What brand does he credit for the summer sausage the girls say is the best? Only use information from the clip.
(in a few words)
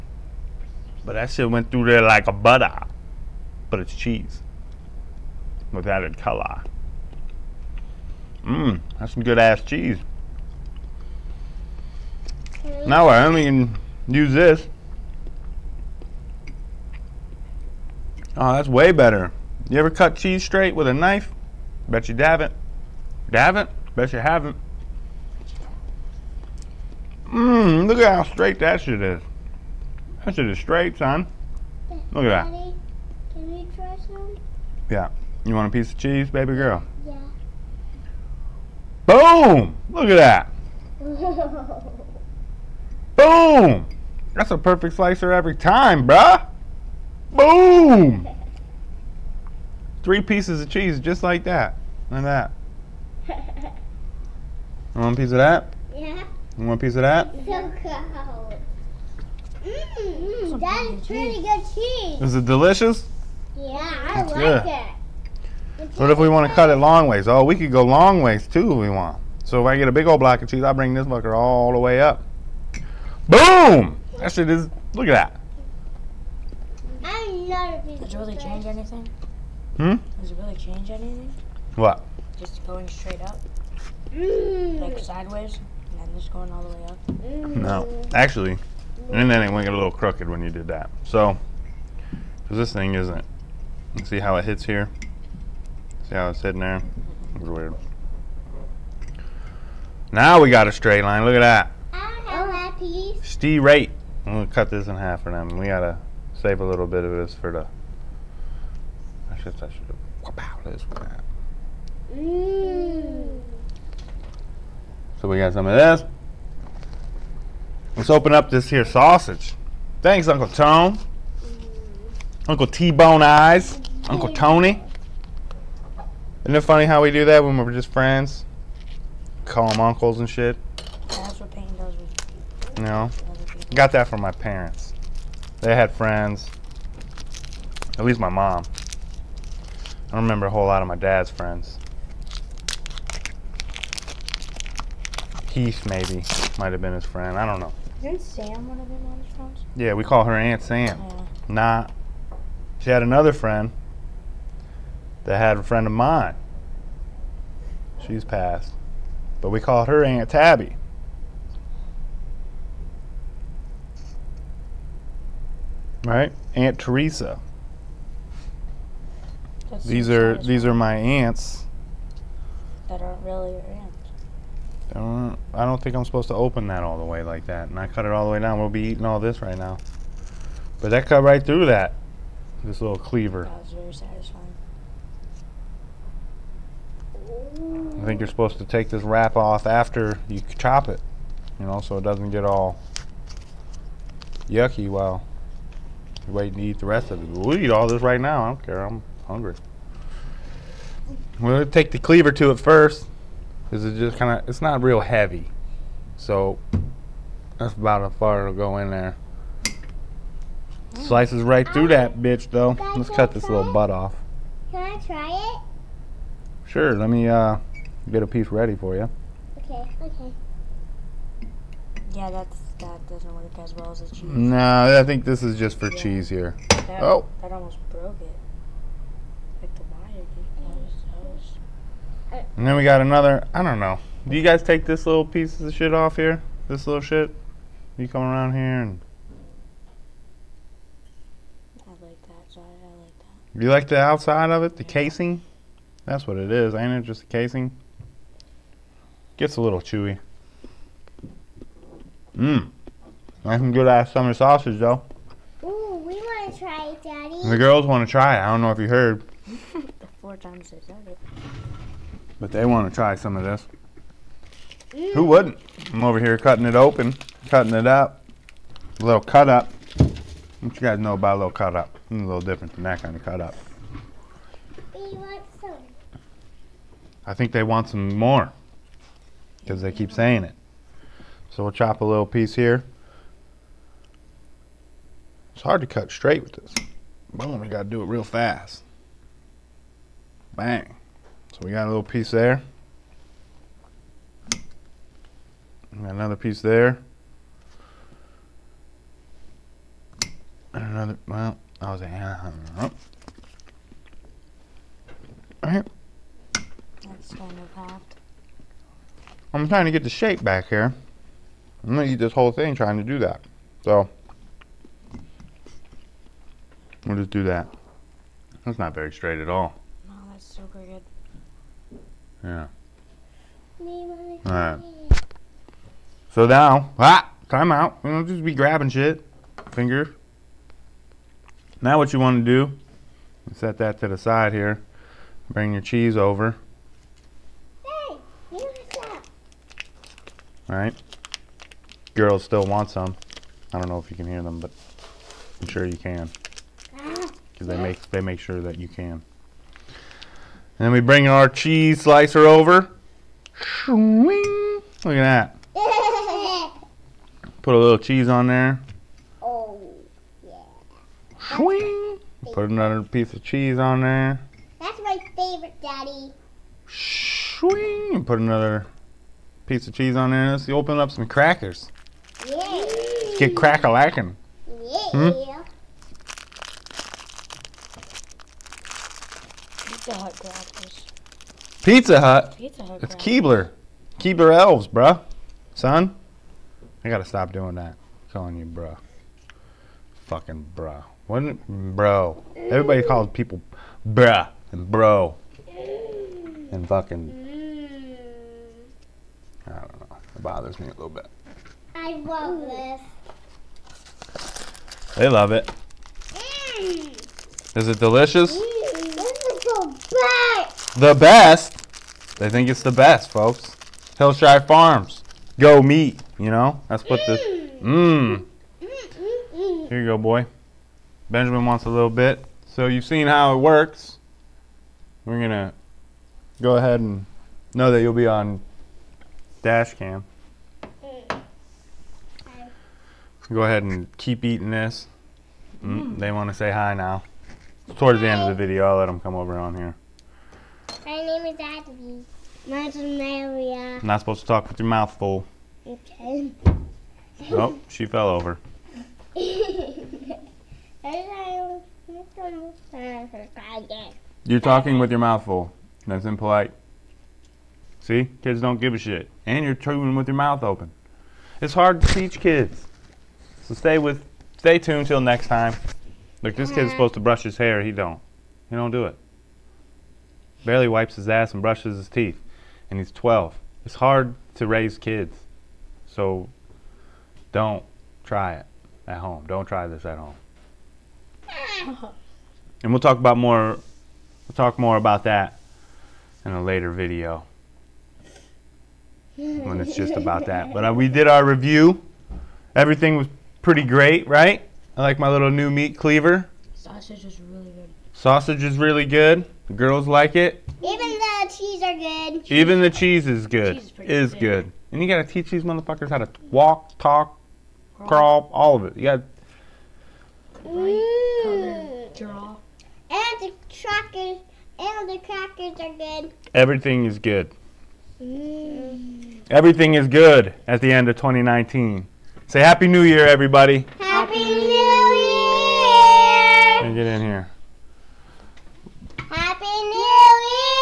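Hillshire Farms.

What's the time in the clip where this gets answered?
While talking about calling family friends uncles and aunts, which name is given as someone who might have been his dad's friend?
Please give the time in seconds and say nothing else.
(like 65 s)
145 s.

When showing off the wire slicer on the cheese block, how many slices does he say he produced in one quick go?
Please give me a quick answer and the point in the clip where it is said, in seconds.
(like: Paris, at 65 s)
3, at 50 s.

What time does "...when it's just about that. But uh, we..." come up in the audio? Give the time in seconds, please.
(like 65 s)
489 s.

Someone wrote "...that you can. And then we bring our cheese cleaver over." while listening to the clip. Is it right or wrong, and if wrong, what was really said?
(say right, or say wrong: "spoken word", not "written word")
wrong: "slicer", not "cleaver".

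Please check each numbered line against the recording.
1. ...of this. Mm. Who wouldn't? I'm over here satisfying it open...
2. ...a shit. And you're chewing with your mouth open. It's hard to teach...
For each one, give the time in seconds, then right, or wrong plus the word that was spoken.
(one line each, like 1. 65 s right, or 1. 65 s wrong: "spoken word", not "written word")
1. 263 s wrong: "cutting", not "satisfying"
2. 458 s right.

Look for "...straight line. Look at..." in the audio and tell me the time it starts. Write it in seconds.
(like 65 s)
100 s.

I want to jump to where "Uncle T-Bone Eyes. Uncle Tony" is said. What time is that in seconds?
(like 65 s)
122 s.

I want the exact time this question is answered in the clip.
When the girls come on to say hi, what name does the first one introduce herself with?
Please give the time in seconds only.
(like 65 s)
441 s.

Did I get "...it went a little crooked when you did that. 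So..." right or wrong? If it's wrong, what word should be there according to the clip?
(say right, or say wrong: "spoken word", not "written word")
right.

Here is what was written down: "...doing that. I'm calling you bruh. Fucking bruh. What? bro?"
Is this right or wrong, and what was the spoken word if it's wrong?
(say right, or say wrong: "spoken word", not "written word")
right.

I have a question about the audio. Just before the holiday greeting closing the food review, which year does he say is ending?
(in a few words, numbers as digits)
2019.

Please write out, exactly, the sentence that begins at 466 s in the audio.
Look, this kid's supposed to brush his hair, he don't.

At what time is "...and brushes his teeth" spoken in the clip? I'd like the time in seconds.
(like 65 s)
471 s.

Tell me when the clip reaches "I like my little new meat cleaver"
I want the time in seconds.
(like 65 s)
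494 s.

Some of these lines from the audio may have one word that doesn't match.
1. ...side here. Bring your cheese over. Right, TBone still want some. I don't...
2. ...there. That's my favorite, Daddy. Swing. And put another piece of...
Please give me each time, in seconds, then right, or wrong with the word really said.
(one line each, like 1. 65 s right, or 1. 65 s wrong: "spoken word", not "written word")
1. 334 s wrong: "Girls", not "TBone"
2. 364 s right.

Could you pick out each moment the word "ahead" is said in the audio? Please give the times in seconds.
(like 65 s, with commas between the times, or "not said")
426 s, 433 s.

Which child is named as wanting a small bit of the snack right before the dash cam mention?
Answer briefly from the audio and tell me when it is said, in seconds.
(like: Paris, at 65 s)
Benjamin, at 421 s.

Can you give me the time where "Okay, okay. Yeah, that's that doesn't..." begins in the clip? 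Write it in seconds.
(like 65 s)
219 s.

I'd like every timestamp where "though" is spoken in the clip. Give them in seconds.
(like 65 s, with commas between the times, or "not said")
212 s, 254 s.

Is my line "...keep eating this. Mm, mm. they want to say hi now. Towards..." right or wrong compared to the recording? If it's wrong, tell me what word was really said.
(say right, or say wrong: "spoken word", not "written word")
right.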